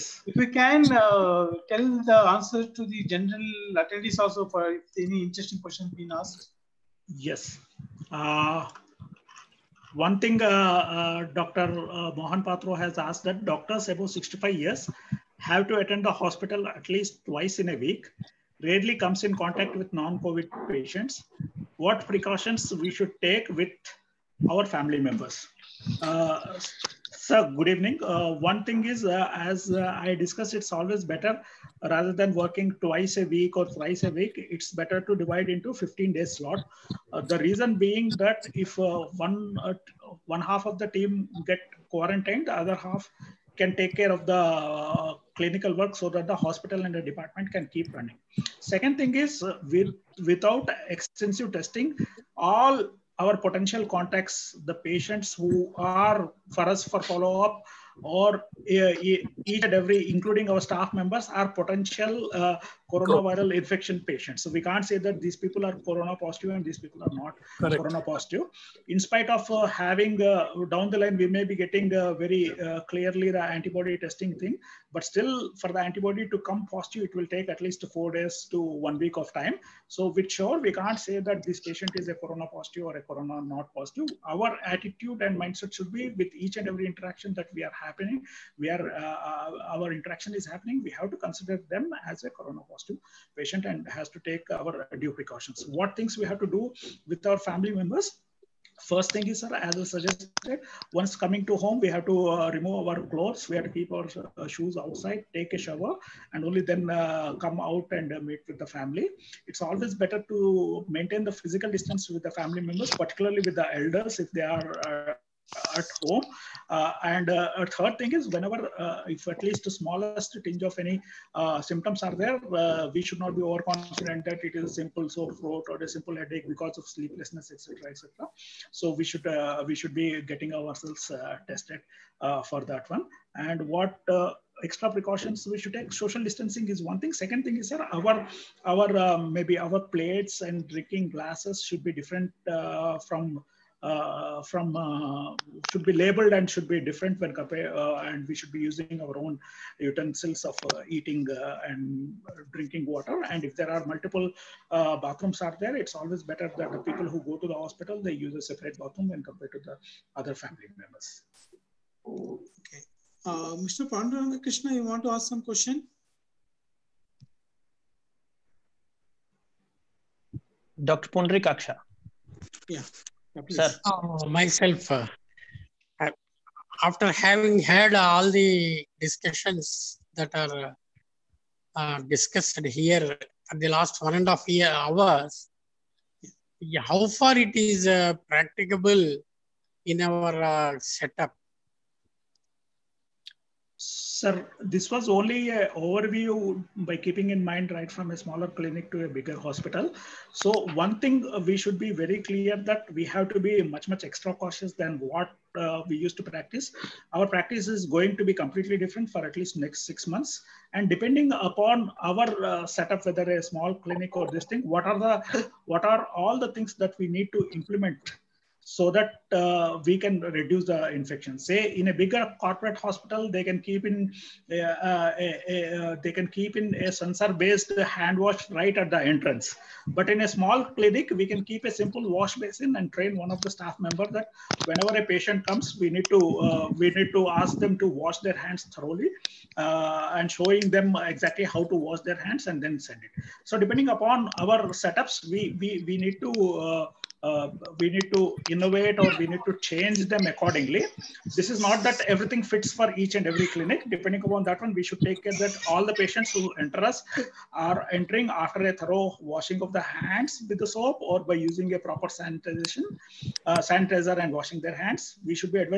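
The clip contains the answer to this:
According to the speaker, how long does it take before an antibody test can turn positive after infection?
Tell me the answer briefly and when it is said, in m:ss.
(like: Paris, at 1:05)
4 days to 1 week, at 1:17.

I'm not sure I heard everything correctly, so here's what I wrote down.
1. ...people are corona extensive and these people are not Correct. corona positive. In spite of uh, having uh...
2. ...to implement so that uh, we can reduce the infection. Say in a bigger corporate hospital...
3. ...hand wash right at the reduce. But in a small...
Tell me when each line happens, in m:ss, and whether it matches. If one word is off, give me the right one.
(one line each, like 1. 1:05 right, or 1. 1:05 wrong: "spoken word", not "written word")
1. 1:05 wrong: "positive", not "extensive"
2. 3:37 right
3. 3:47 wrong: "entrance", not "reduce".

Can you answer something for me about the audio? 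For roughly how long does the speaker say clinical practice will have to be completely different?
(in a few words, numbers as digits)
6 months.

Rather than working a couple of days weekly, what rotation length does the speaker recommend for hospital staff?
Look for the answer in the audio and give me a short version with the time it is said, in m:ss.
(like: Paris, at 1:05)
15-day slots, at 0:35.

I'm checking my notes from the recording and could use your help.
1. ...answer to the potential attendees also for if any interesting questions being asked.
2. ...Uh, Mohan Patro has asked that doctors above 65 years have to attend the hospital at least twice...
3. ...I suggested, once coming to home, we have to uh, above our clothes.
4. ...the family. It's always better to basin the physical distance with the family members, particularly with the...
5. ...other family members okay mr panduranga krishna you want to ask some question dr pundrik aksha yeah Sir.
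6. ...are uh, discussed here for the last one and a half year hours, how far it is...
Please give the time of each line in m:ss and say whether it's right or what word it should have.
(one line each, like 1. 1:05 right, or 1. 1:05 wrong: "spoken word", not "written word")
1. 0:02 wrong: "general", not "potential"
2. 0:11 right
3. 1:39 wrong: "remove", not "above"
4. 1:48 wrong: "maintain", not "basin"
5. 2:40 right
6. 3:00 right.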